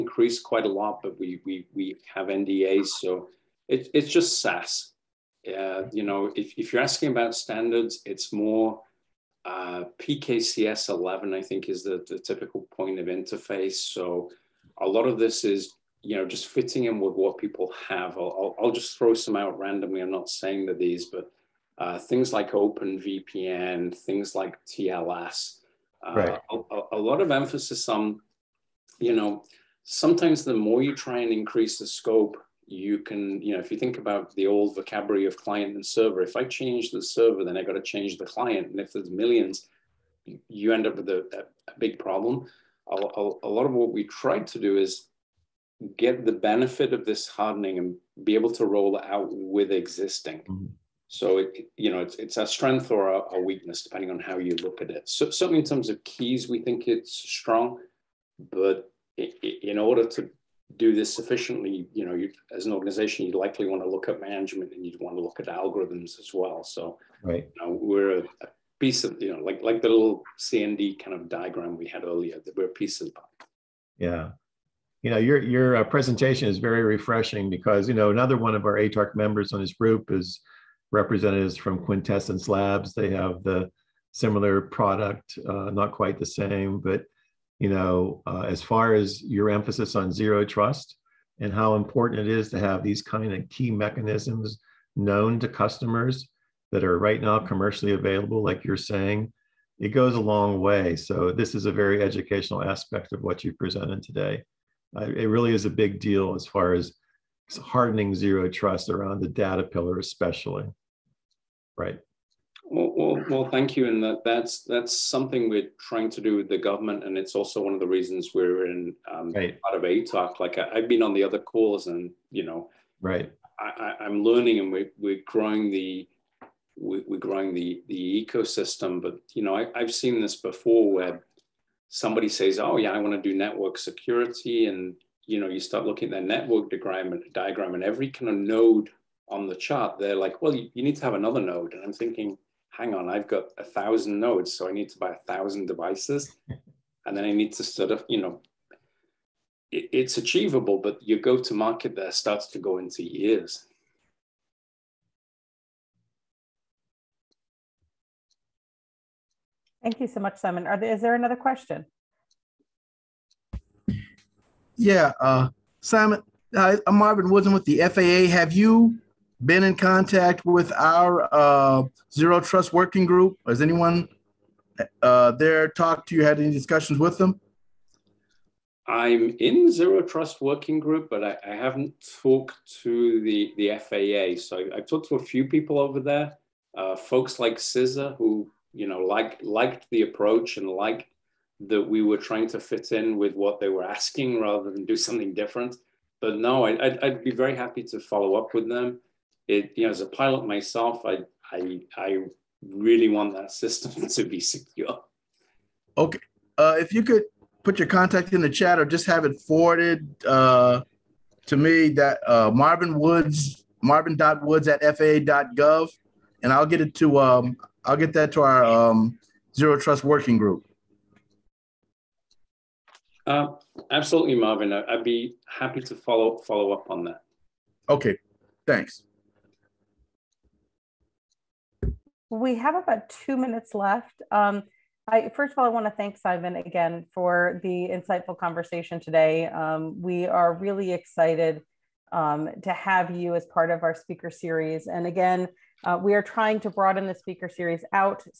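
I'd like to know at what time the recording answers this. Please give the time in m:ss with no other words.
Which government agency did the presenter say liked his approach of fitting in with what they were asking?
3:07.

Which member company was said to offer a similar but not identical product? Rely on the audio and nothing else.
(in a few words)
Quintessence Labs.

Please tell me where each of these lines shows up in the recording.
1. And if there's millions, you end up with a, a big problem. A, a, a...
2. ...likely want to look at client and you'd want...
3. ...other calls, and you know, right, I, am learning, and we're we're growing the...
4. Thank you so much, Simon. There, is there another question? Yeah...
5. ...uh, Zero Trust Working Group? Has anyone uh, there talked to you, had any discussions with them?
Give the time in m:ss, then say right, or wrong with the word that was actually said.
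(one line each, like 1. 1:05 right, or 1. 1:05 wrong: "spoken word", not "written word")
1. 0:38 right
2. 1:03 wrong: "management", not "client"
3. 2:01 right
4. 2:39 right
5. 2:51 right.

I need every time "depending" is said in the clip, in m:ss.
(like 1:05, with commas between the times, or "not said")
0:53.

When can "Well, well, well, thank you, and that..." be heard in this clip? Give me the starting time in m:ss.
1:52.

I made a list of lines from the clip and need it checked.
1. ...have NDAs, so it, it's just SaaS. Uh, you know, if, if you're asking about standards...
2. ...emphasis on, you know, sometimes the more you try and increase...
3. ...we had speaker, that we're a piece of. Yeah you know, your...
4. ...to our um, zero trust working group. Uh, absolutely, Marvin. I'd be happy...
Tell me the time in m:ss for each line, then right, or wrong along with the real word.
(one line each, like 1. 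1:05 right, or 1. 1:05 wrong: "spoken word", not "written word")
1. 0:02 right
2. 0:27 right
3. 1:11 wrong: "earlier", not "speaker"
4. 3:38 right.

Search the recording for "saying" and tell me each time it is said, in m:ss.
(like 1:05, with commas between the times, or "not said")
0:20, 1:38.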